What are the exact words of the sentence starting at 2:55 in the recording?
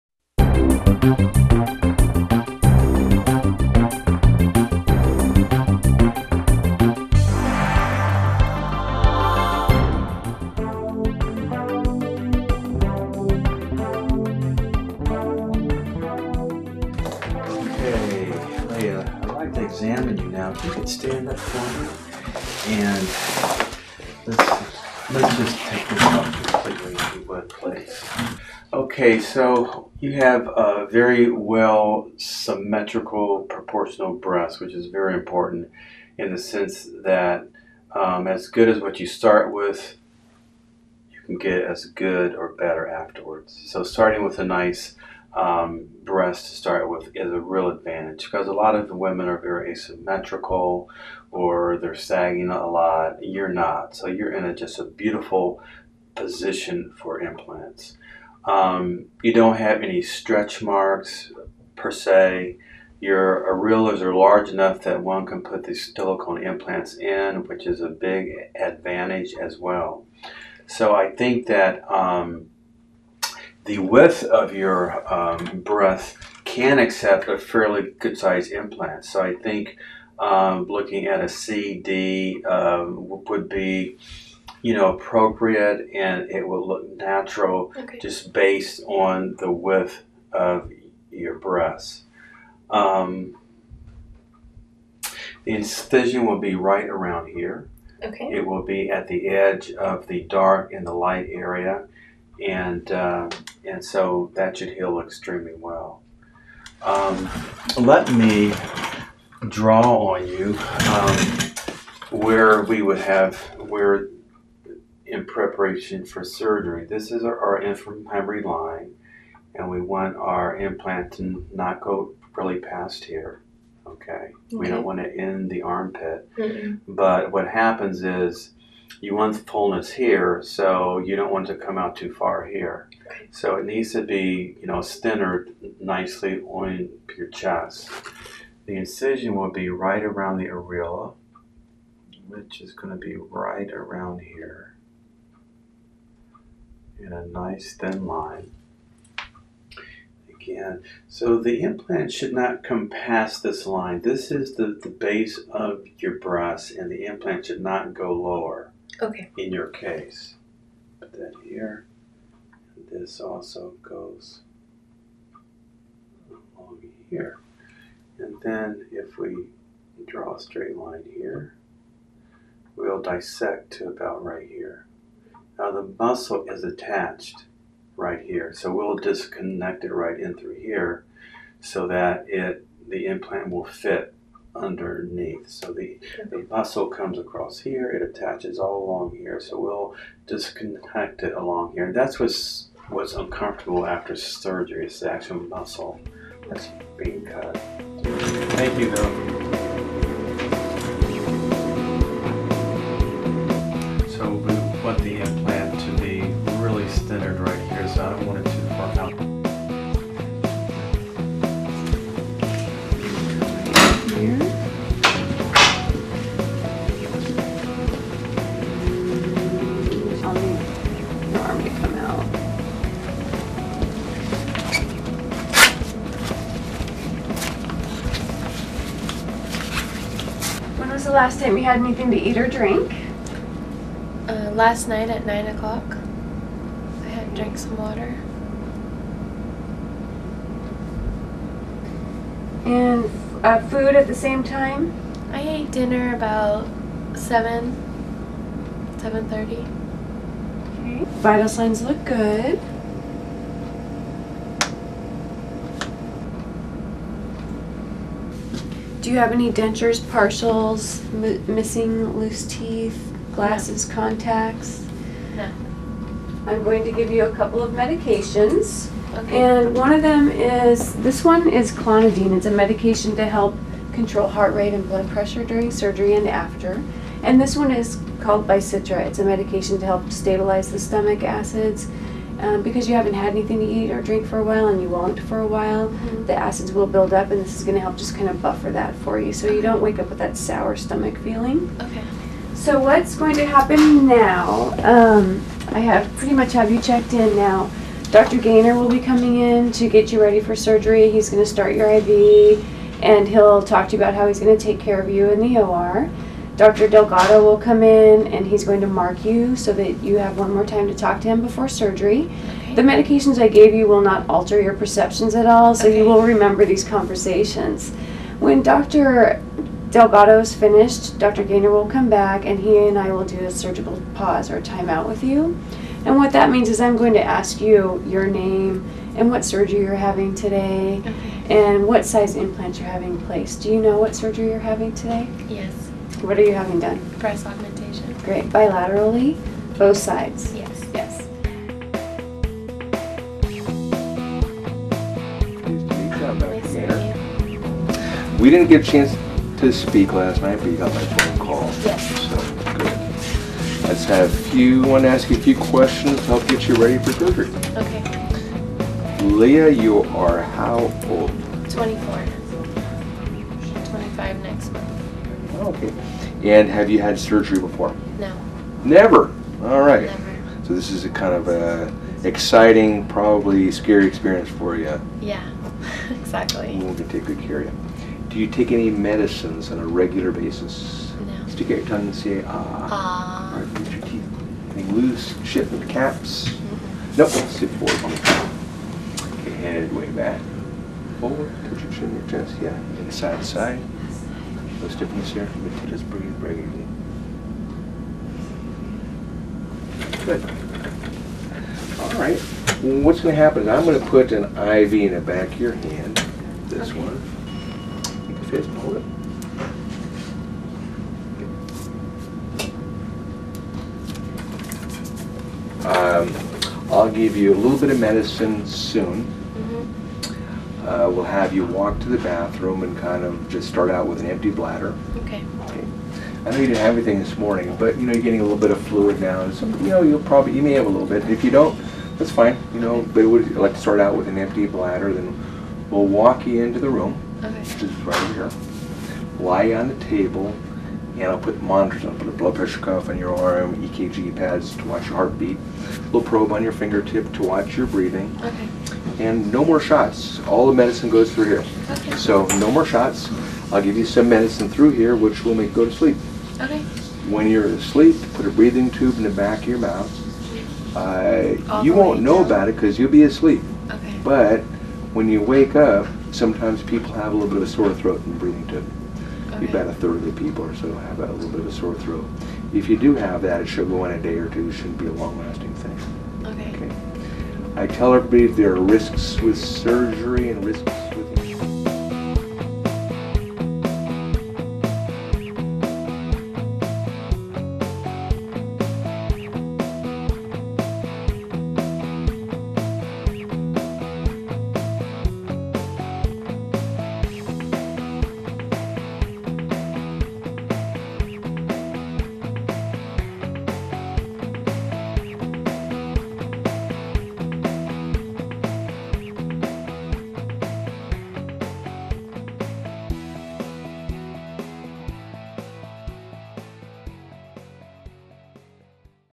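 Now uh, the muscle is attached right here.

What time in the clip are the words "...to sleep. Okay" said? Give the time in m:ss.
7:35.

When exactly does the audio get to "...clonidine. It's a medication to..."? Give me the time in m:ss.
4:31.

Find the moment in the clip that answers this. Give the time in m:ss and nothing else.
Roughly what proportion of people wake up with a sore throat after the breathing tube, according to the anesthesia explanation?
7:49.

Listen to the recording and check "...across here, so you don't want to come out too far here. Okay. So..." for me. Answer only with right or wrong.
wrong.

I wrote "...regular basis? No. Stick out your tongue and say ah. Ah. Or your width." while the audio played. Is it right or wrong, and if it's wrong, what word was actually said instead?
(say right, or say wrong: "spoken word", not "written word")
wrong: "teeth", not "width".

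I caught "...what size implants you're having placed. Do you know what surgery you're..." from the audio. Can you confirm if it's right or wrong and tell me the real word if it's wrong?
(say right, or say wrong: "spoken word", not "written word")
right.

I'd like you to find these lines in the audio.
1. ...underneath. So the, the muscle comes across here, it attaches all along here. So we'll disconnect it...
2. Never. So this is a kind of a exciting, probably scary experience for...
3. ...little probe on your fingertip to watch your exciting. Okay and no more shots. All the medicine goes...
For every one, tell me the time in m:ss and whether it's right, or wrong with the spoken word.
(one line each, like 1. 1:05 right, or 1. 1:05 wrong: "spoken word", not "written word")
1. 3:04 right
2. 6:10 right
3. 7:26 wrong: "breathing", not "exciting".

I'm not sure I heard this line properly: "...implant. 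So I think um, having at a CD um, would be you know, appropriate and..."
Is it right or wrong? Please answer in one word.
wrong.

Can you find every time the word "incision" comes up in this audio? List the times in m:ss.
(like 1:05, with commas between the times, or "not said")
1:35, 2:18.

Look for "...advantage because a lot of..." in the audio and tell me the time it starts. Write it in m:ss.
0:47.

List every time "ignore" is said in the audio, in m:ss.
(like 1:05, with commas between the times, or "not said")
not said.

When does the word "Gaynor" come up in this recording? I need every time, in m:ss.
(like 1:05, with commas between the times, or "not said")
4:58, 5:21.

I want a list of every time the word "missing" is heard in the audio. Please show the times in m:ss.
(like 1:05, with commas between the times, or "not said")
4:21.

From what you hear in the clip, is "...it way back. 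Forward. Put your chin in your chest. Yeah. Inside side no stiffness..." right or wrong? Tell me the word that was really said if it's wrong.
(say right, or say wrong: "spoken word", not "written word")
right.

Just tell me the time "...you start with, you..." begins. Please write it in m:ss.
0:39.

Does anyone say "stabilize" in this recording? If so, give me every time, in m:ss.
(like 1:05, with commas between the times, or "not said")
4:40.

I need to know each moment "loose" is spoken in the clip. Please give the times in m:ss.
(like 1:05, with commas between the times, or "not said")
4:22, 6:24.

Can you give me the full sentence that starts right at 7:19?
Lie on the table, and I'll put monitors.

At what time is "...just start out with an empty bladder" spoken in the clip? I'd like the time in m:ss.
7:03.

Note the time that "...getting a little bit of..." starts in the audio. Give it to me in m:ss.
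7:08.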